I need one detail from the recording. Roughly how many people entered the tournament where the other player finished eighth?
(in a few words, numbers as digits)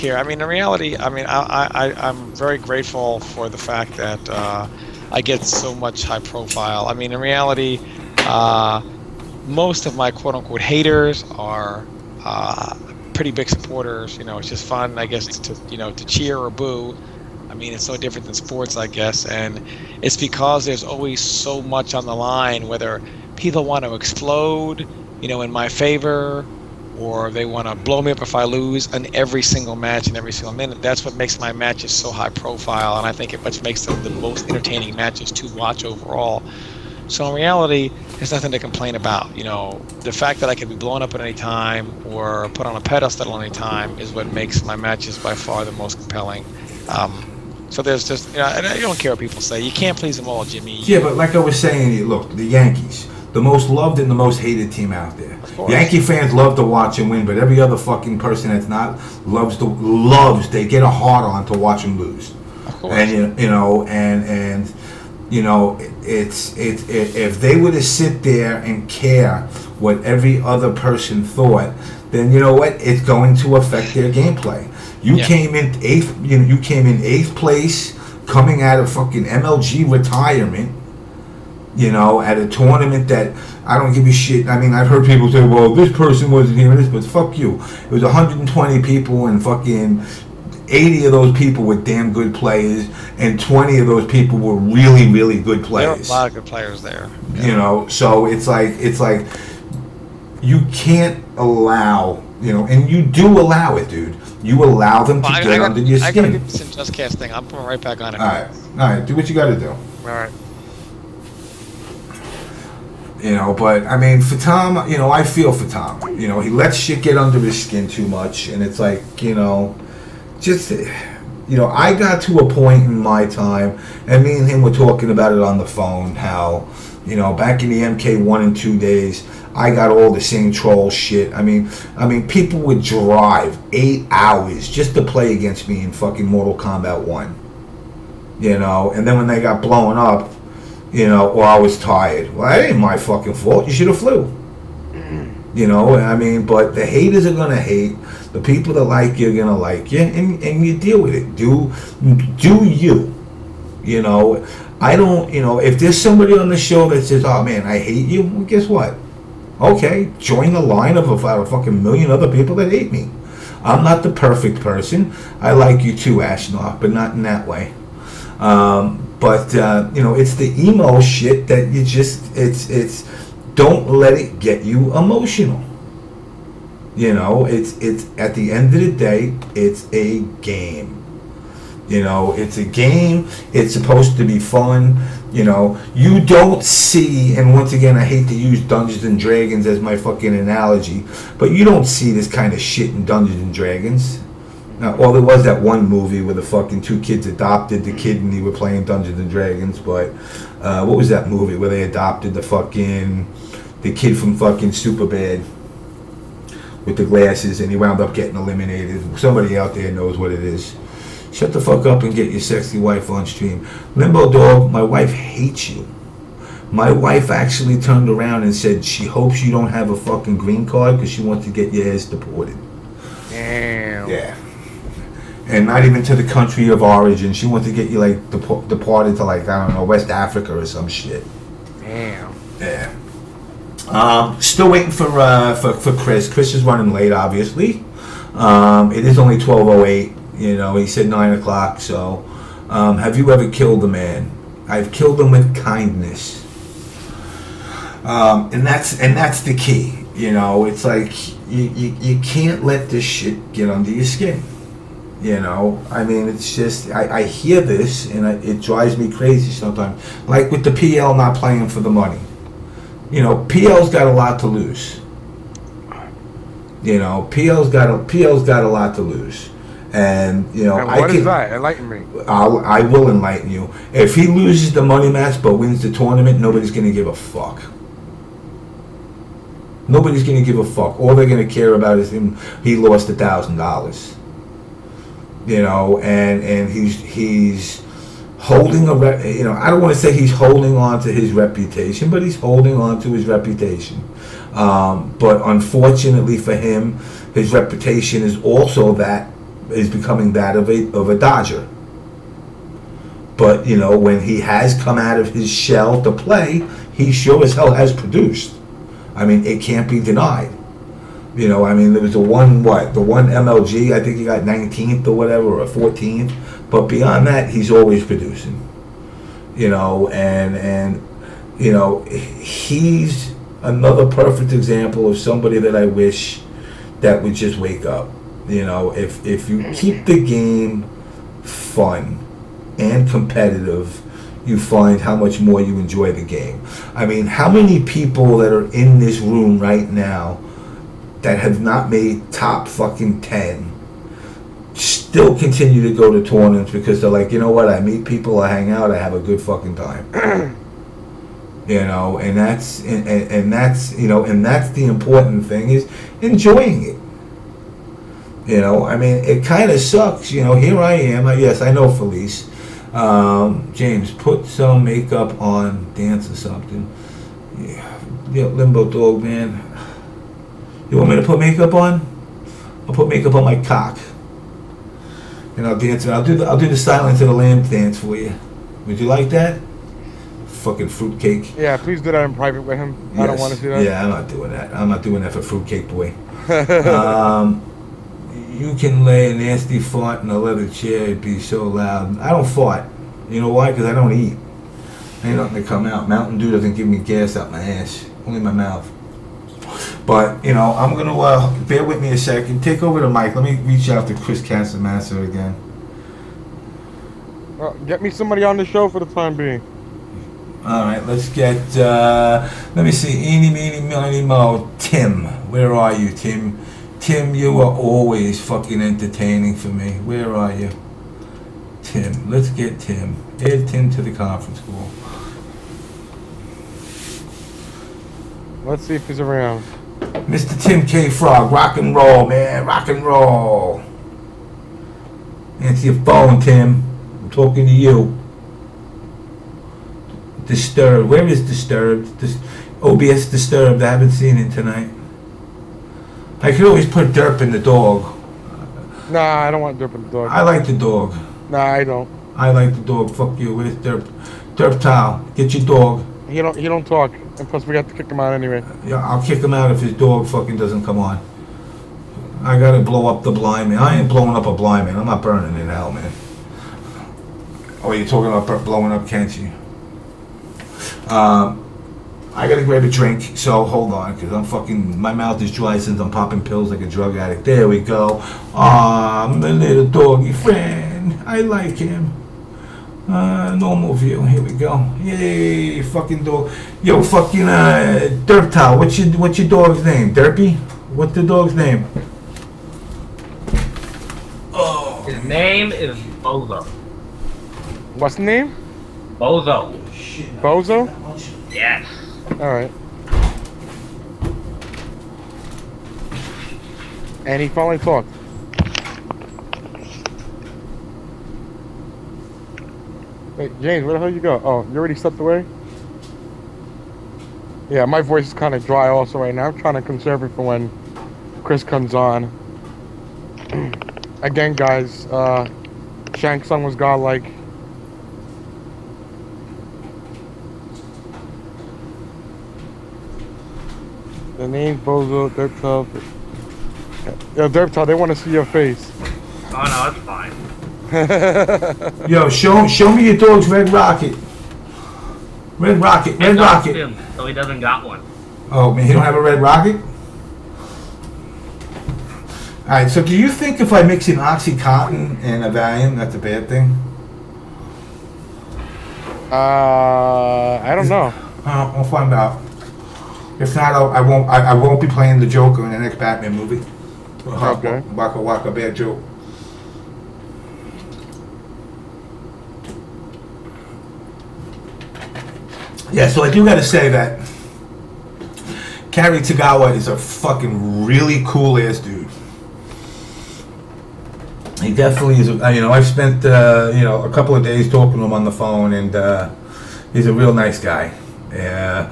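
120.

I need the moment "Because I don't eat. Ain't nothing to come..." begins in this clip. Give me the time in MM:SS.
06:33.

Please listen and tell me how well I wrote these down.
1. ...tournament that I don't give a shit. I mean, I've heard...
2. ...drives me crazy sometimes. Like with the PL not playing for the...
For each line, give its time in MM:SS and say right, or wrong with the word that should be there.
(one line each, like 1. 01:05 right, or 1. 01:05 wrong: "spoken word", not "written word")
1. 01:22 right
2. 04:18 right.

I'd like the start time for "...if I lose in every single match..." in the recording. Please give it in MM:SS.
00:28.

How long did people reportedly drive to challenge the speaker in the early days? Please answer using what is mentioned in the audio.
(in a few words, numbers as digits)
8 hours.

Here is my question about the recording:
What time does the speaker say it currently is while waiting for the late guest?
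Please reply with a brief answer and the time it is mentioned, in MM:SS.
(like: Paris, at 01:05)
12:08, at 03:59.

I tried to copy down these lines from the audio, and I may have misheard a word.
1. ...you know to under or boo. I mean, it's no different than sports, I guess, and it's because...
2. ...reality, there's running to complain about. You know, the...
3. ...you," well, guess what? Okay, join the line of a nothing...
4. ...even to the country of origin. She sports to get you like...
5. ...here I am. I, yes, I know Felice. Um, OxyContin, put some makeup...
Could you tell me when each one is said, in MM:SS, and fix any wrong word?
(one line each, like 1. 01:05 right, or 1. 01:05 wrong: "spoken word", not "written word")
1. 00:15 wrong: "cheer", not "under"
2. 00:37 wrong: "nothing", not "running"
3. 02:38 wrong: "fucking", not "nothing"
4. 03:45 wrong: "wants", not "sports"
5. 06:00 wrong: "James", not "OxyContin".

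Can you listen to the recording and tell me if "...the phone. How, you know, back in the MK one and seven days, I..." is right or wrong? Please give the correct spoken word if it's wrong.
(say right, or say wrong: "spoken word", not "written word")
wrong: "two", not "seven".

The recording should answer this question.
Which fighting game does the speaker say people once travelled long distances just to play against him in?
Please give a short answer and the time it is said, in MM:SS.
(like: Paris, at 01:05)
Mortal Kombat, at 02:16.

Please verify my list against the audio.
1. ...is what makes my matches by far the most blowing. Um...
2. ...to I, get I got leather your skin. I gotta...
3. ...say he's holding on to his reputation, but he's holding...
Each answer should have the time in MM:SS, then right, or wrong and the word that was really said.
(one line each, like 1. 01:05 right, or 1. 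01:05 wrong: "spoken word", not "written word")
1. 00:43 wrong: "compelling", not "blowing"
2. 01:45 wrong: "under", not "leather"
3. 04:49 right.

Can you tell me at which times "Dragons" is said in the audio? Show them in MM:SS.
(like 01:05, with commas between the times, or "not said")
03:09, 03:13, 03:19.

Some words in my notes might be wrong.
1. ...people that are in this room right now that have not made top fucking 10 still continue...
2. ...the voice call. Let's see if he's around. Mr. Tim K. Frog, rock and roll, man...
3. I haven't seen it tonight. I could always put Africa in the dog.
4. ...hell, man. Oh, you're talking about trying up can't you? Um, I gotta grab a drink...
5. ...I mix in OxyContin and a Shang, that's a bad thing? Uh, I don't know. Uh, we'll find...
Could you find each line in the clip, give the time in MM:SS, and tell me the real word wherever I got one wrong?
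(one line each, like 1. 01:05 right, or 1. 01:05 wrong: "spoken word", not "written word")
1. 05:37 right
2. 07:04 wrong: "conference", not "voice"
3. 07:23 wrong: "Derp", not "Africa"
4. 07:45 wrong: "blowing", not "trying"
5. 09:13 wrong: "Valium", not "Shang".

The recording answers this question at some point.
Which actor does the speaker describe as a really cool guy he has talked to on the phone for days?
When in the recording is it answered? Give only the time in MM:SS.
09:38.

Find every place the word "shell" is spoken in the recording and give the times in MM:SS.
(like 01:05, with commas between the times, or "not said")
05:05.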